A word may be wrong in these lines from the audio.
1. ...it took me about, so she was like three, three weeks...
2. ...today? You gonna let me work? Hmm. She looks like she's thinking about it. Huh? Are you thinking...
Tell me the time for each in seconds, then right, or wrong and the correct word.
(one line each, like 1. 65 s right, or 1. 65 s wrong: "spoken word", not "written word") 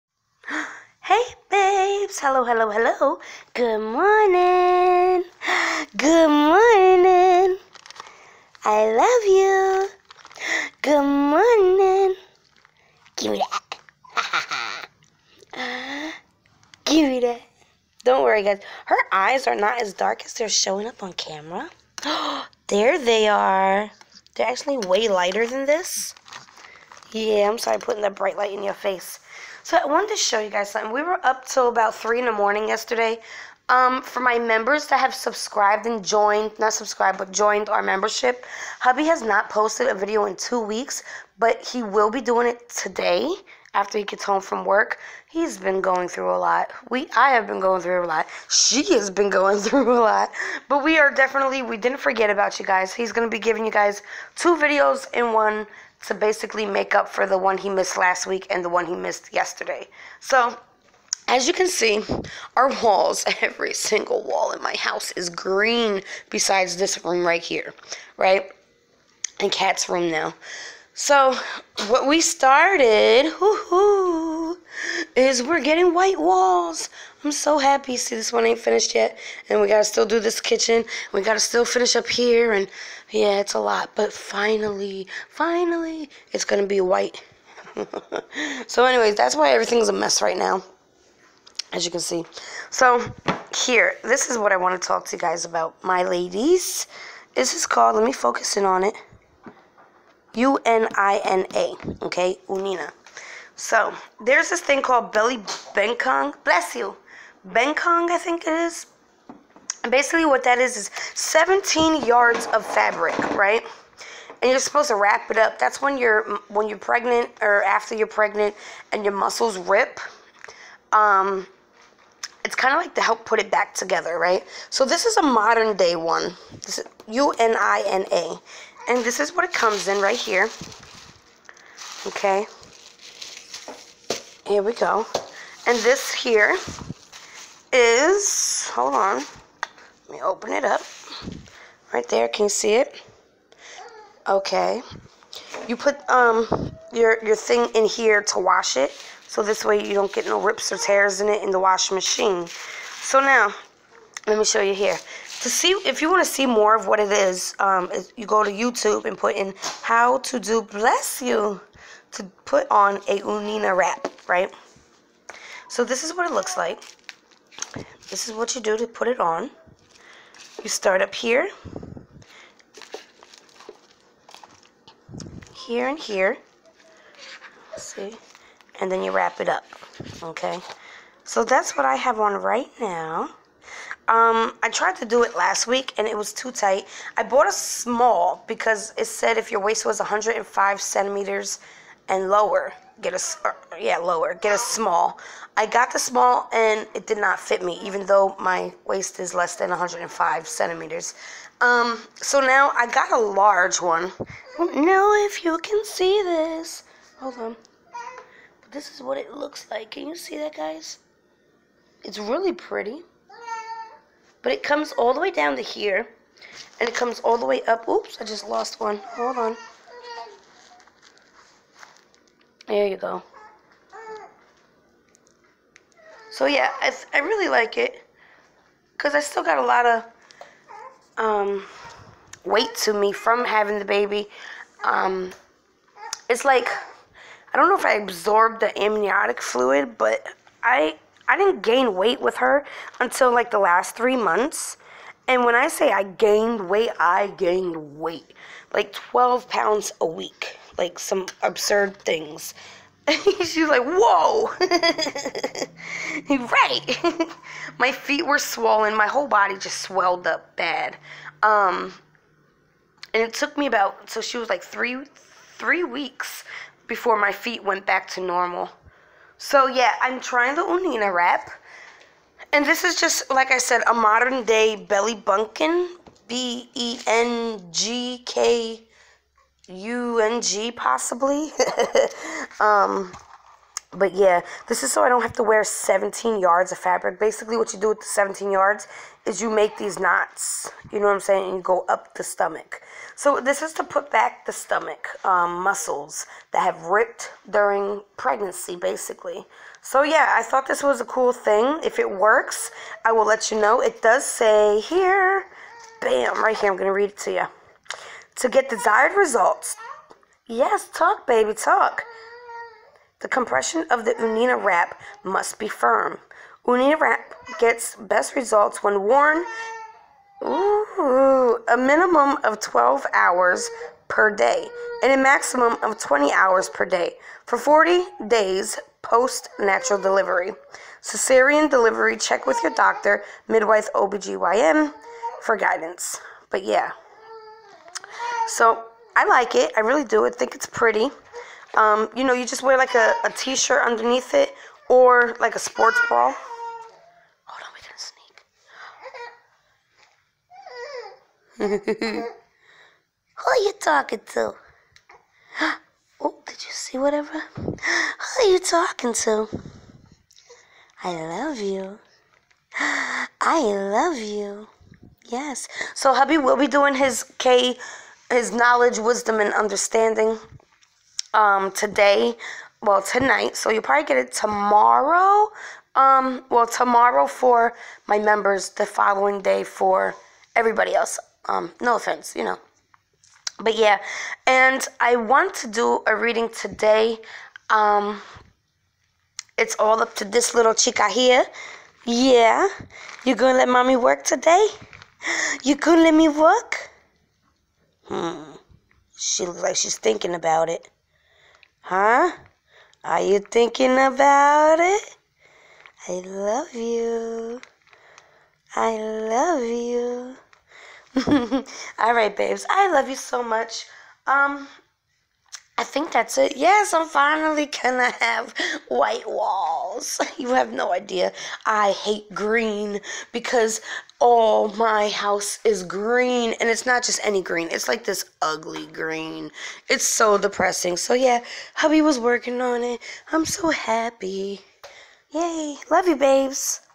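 1. 263 s right
2. 394 s right.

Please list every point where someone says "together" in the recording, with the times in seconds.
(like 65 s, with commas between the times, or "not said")
123 s.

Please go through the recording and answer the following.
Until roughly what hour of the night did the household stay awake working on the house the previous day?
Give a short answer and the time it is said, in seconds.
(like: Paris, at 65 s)
3 in the morning, at 31 s.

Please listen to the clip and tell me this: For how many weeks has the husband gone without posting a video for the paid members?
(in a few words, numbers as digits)
2.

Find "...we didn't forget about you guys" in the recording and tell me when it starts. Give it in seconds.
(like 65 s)
51 s.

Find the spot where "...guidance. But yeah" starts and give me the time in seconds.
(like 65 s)
335 s.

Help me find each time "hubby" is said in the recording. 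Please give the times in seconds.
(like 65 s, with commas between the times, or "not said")
38 s, 366 s, 431 s.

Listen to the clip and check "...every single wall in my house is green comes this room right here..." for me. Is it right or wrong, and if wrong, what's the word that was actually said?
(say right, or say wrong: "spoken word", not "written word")
wrong: "besides", not "comes".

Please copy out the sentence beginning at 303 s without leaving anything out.
It does say here, bam, right here, I'm going to read it to you to get desired results.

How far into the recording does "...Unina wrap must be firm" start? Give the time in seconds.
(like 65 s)
314 s.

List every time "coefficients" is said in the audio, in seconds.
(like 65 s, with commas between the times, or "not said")
not said.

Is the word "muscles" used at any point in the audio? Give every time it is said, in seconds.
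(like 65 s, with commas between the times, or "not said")
119 s, 295 s.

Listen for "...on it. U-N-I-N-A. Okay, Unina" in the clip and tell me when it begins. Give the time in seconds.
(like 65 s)
98 s.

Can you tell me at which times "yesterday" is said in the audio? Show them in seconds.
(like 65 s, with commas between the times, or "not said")
32 s, 59 s.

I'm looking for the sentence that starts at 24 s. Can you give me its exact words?
They're actually way lighter than this.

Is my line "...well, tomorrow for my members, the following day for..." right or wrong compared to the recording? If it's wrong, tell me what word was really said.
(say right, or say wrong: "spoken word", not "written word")
right.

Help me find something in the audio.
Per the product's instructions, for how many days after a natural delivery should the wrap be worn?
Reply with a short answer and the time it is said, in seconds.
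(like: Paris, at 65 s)
40, at 327 s.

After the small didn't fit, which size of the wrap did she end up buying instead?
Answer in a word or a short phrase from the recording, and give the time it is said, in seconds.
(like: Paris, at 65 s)
Large, at 203 s.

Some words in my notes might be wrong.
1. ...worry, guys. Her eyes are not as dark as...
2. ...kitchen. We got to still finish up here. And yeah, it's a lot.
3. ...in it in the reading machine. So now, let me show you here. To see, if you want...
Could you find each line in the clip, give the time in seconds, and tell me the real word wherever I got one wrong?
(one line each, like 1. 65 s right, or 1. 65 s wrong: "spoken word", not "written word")
1. 18 s right
2. 80 s right
3. 151 s wrong: "washing", not "reading".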